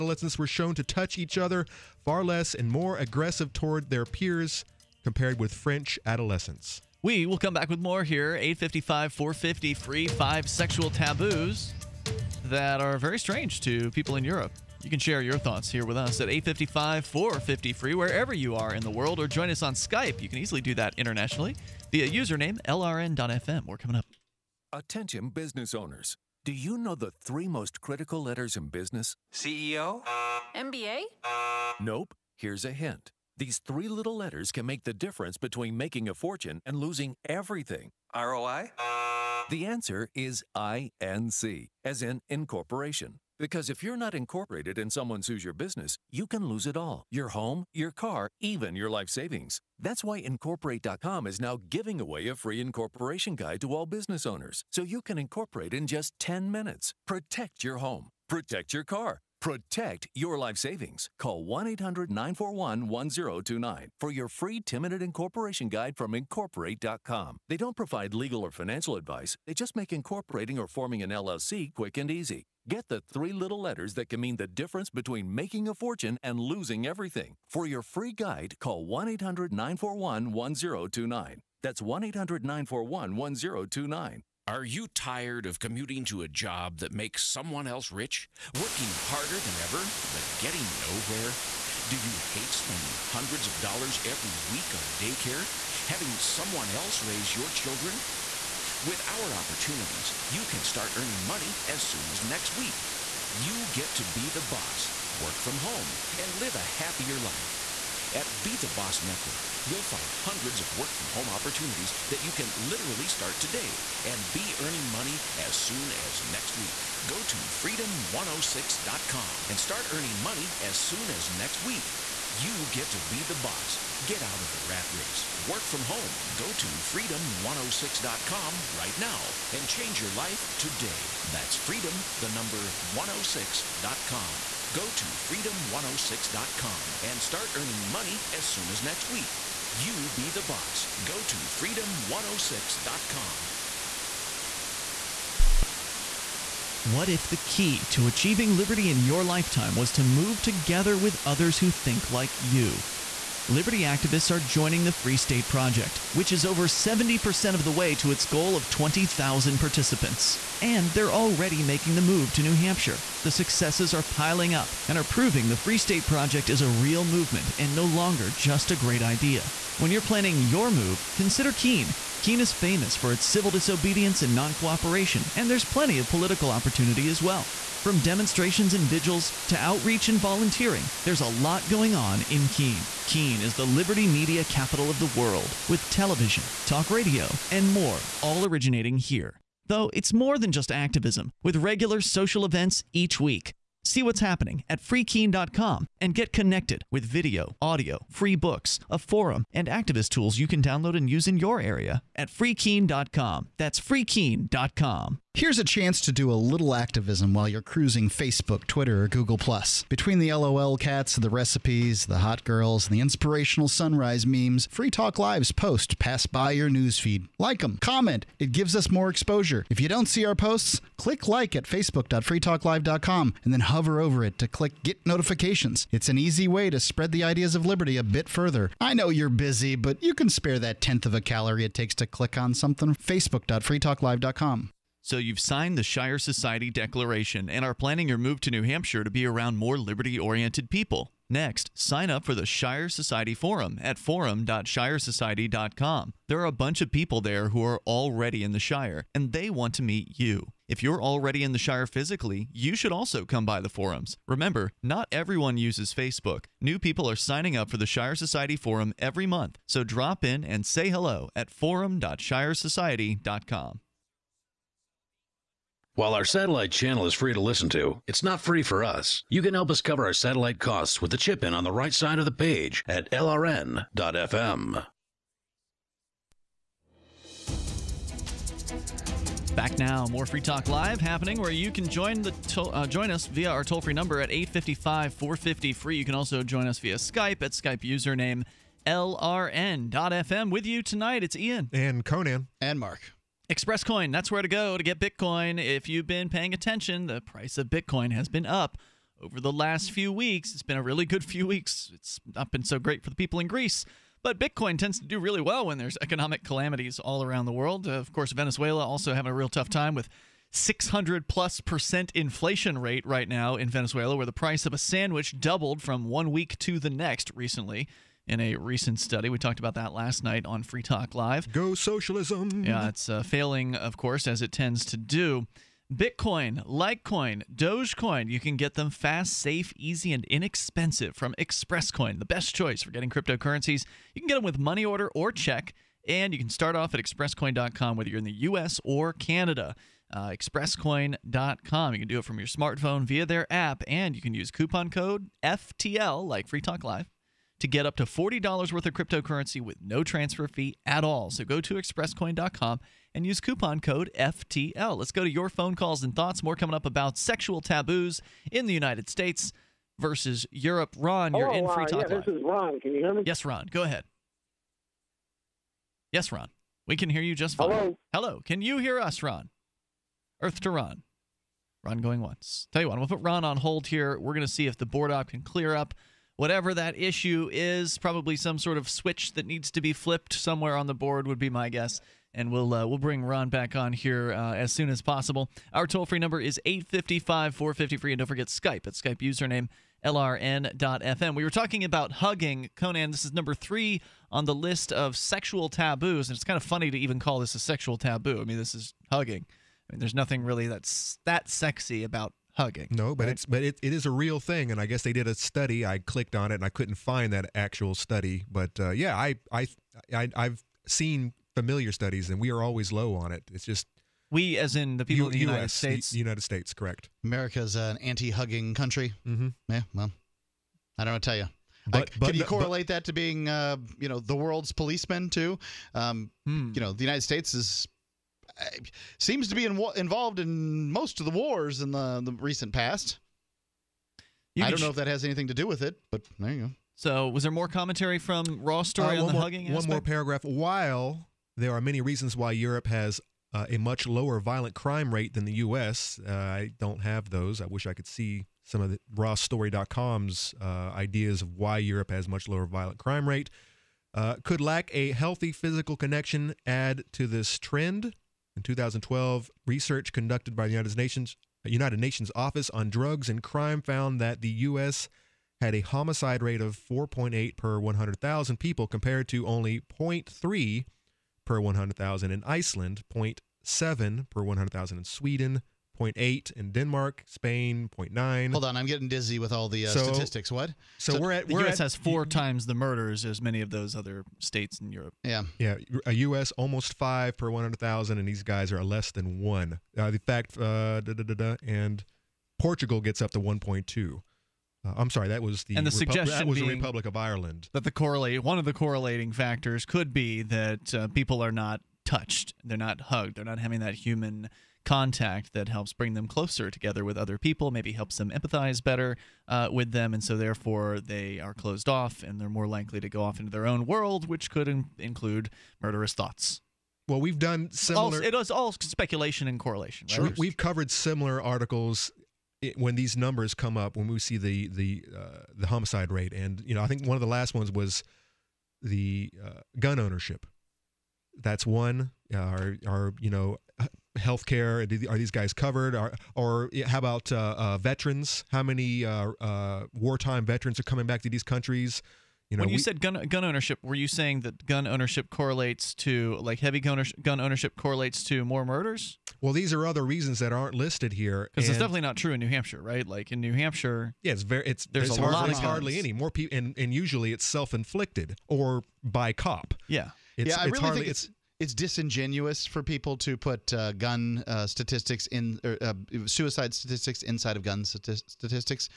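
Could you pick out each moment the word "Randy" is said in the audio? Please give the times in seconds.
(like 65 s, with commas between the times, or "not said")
not said.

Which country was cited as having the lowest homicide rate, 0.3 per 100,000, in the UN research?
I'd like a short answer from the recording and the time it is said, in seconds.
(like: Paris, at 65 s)
Iceland, at 472 s.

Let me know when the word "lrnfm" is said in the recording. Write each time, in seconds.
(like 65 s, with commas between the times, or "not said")
22 s, 273 s, 288 s, 390 s.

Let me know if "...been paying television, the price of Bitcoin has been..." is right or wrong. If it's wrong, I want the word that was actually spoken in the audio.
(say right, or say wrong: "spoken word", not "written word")
wrong: "attention", not "television".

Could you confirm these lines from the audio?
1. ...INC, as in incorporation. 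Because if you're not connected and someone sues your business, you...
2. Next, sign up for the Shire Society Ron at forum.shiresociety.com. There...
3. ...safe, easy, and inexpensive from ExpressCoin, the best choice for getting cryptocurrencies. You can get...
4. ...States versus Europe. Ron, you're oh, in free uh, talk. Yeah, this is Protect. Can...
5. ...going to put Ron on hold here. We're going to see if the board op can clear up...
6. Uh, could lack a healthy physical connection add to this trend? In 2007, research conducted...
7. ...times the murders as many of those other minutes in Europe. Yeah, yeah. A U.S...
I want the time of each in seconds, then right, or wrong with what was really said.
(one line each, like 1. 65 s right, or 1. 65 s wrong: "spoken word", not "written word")
1. 40 s wrong: "incorporated", not "connected"
2. 241 s wrong: "Forum", not "Ron"
3. 329 s right
4. 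359 s wrong: "Ron", not "Protect"
5. 372 s right
6. 454 s wrong: "2012", not "2007"
7. 482 s wrong: "states", not "minutes".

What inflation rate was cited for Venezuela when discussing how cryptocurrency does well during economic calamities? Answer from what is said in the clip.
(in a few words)
600 plus percent.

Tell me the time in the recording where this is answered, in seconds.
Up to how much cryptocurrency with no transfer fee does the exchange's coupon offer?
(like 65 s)
348 s.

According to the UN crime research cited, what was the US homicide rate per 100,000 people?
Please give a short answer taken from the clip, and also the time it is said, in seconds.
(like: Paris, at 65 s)
4.8, at 466 s.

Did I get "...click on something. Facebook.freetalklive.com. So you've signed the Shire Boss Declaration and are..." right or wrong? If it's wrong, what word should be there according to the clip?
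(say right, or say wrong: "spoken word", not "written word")
wrong: "Society", not "Boss".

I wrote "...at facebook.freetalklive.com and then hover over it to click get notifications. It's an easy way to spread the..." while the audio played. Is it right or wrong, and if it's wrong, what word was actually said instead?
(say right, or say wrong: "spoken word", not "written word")
right.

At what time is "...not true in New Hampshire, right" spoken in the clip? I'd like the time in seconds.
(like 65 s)
552 s.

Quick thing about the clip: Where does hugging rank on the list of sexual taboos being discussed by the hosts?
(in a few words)
Number three.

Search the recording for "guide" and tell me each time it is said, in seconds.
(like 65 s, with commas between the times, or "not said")
53 s, 65 s, 78 s.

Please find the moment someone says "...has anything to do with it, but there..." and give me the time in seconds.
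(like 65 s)
435 s.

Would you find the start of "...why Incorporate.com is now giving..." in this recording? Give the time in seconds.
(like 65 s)
50 s.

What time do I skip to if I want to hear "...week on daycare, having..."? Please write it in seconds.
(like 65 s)
94 s.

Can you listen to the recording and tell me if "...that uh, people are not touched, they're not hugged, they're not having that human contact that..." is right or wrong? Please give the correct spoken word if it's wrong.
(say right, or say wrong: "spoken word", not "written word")
right.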